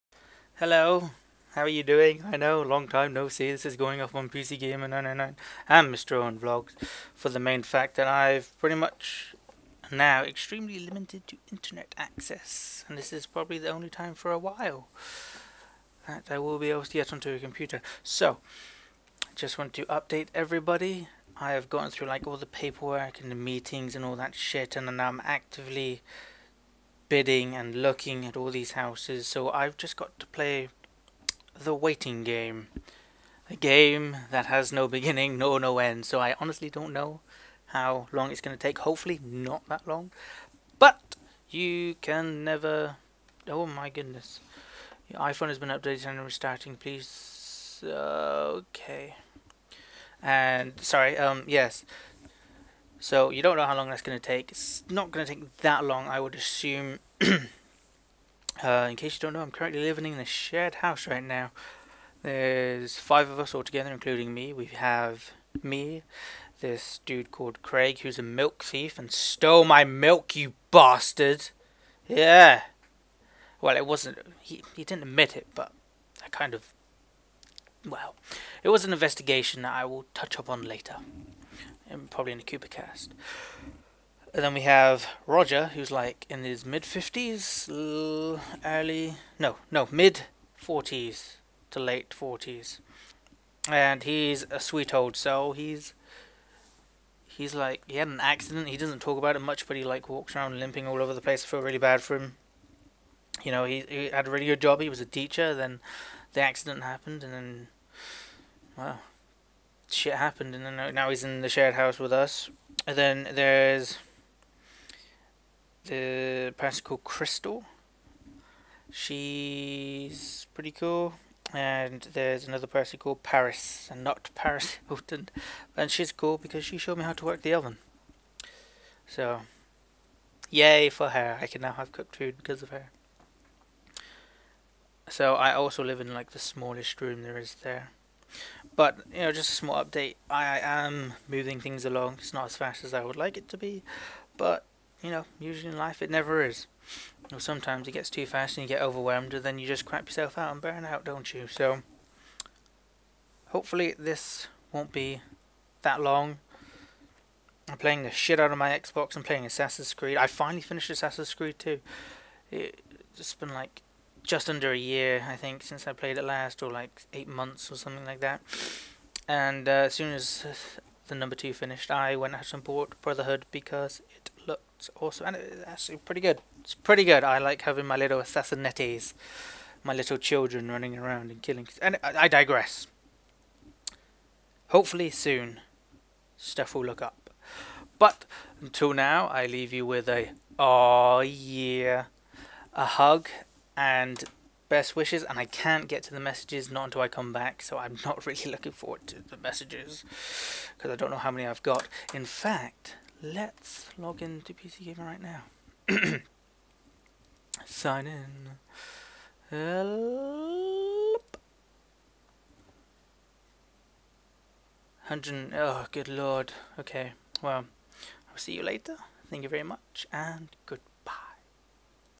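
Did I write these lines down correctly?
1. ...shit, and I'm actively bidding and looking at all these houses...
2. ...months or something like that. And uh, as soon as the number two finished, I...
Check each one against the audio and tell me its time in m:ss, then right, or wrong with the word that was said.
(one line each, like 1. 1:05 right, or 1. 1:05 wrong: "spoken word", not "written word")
1. 0:24 right
2. 2:47 right.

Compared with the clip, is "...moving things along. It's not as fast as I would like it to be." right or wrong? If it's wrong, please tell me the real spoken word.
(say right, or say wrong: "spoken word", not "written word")
right.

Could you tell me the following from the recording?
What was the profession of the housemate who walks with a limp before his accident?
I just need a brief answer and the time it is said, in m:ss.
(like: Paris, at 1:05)
Teacher, at 1:45.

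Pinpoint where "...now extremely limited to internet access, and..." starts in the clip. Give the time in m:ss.
0:09.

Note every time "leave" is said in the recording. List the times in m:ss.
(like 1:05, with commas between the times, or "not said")
3:09.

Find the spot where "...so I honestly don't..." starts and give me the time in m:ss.
0:36.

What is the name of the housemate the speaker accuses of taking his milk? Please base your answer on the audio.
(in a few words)
Craig.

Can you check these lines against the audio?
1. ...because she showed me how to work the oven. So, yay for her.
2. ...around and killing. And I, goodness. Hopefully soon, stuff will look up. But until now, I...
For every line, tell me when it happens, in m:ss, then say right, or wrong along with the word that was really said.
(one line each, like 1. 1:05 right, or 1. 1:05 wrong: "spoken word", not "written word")
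1. 2:06 right
2. 3:00 wrong: "digress", not "goodness".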